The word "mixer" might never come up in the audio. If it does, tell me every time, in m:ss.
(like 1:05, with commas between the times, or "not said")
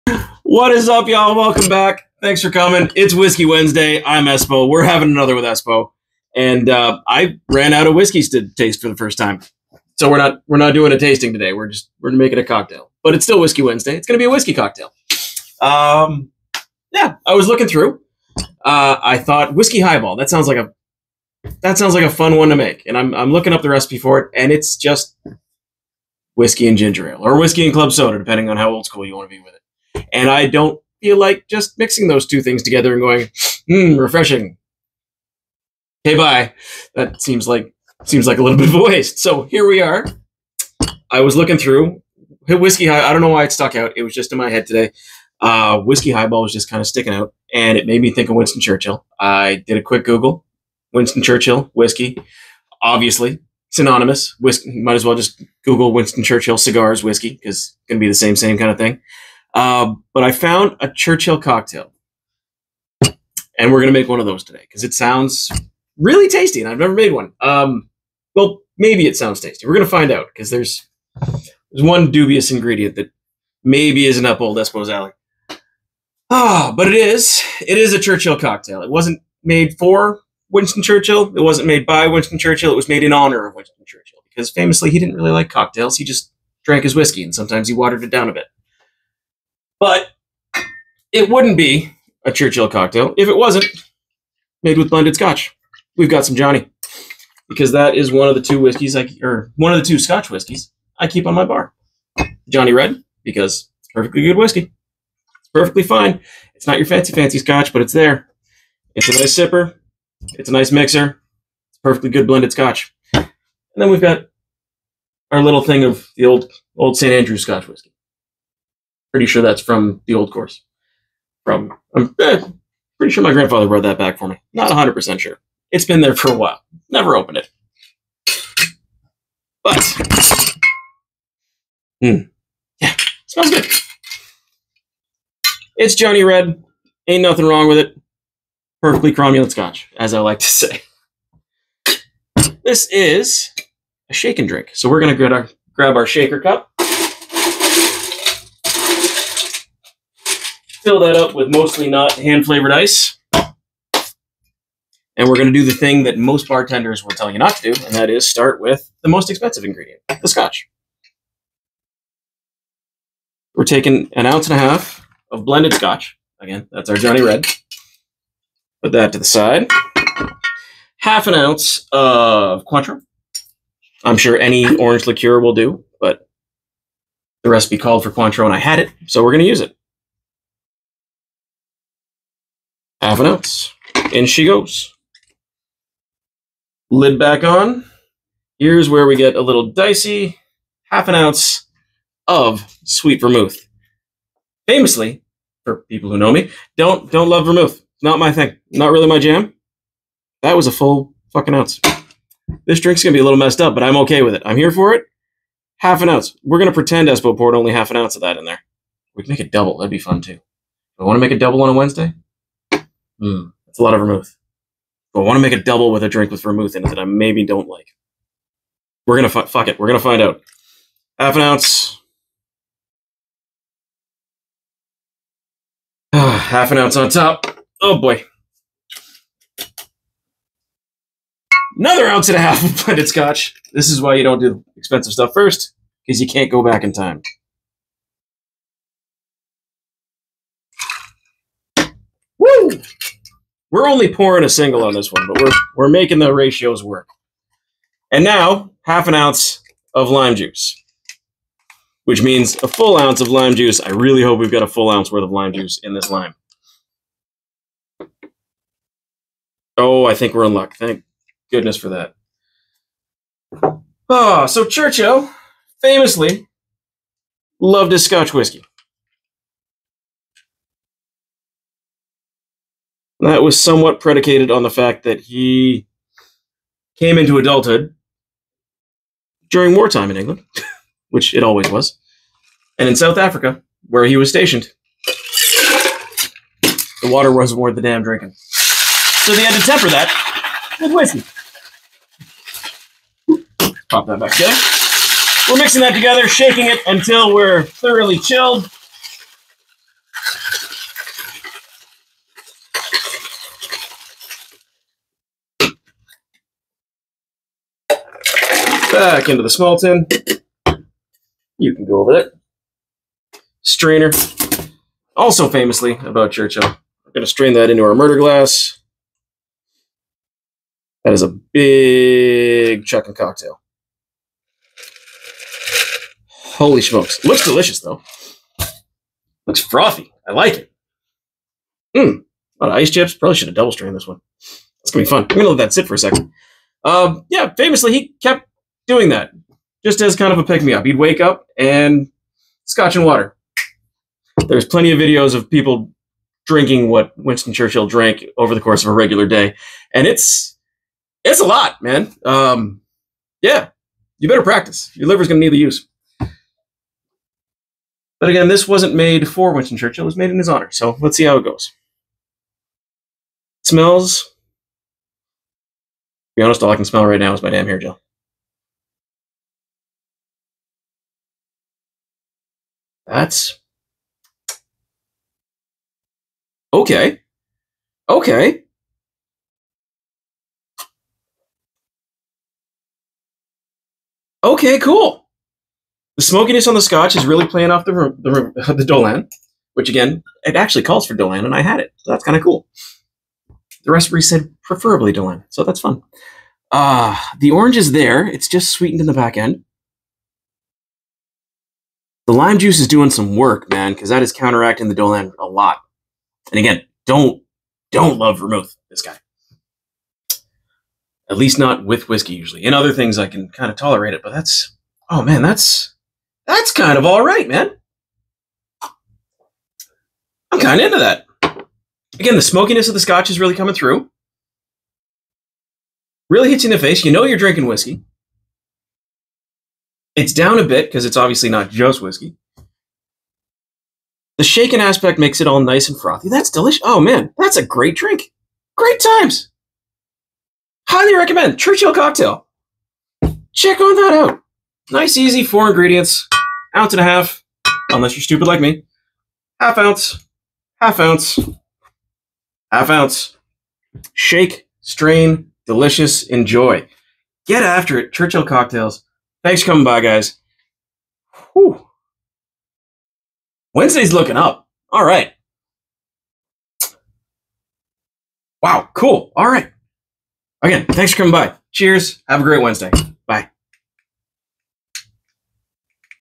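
1:50.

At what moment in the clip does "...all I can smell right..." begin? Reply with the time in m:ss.
6:06.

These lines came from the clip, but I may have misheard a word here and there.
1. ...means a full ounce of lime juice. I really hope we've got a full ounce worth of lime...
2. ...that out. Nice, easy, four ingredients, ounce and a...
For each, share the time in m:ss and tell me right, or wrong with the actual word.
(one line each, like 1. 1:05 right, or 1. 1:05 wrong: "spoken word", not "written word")
1. 4:12 right
2. 7:23 right.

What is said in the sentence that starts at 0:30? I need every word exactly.
And I don't feel like just mixing those two things together and going, hmm, refreshing.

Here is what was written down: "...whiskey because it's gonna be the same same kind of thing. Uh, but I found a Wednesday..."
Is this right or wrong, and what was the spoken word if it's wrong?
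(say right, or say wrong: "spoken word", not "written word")
wrong: "Churchill", not "Wednesday".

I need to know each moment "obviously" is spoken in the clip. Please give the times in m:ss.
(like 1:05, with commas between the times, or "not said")
0:52, 7:11.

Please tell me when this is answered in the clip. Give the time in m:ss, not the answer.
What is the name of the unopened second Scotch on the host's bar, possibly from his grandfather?
1:56.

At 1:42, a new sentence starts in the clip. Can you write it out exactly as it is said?
Johnny Red because it's perfectly good whiskey.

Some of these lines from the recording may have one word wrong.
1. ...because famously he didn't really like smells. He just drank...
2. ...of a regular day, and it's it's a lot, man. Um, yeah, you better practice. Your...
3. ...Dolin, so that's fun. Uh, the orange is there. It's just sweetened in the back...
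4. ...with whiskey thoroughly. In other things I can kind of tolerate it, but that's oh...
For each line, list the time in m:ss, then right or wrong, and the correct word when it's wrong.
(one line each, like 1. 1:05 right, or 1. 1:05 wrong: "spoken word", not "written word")
1. 1:24 wrong: "cocktails", not "smells"
2. 5:48 right
3. 6:35 right
4. 6:51 wrong: "usually", not "thoroughly".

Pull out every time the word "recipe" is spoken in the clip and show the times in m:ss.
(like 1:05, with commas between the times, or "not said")
0:23, 2:57, 6:33.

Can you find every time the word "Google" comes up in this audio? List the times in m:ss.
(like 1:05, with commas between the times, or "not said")
0:50, 0:55.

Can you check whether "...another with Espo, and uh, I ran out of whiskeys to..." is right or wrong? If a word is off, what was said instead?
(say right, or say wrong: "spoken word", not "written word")
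right.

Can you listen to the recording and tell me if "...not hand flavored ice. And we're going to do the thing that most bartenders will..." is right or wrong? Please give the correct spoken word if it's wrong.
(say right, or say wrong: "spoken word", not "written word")
right.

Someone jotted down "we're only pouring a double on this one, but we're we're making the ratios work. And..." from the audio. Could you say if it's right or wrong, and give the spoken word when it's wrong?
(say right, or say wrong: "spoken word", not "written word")
wrong: "single", not "double".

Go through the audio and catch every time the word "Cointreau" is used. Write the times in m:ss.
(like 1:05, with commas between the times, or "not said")
2:52, 2:58.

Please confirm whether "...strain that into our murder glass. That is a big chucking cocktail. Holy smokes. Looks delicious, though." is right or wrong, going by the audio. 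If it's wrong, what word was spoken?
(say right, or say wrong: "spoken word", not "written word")
right.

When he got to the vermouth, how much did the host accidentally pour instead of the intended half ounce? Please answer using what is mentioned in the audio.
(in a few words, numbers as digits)
1 ounce.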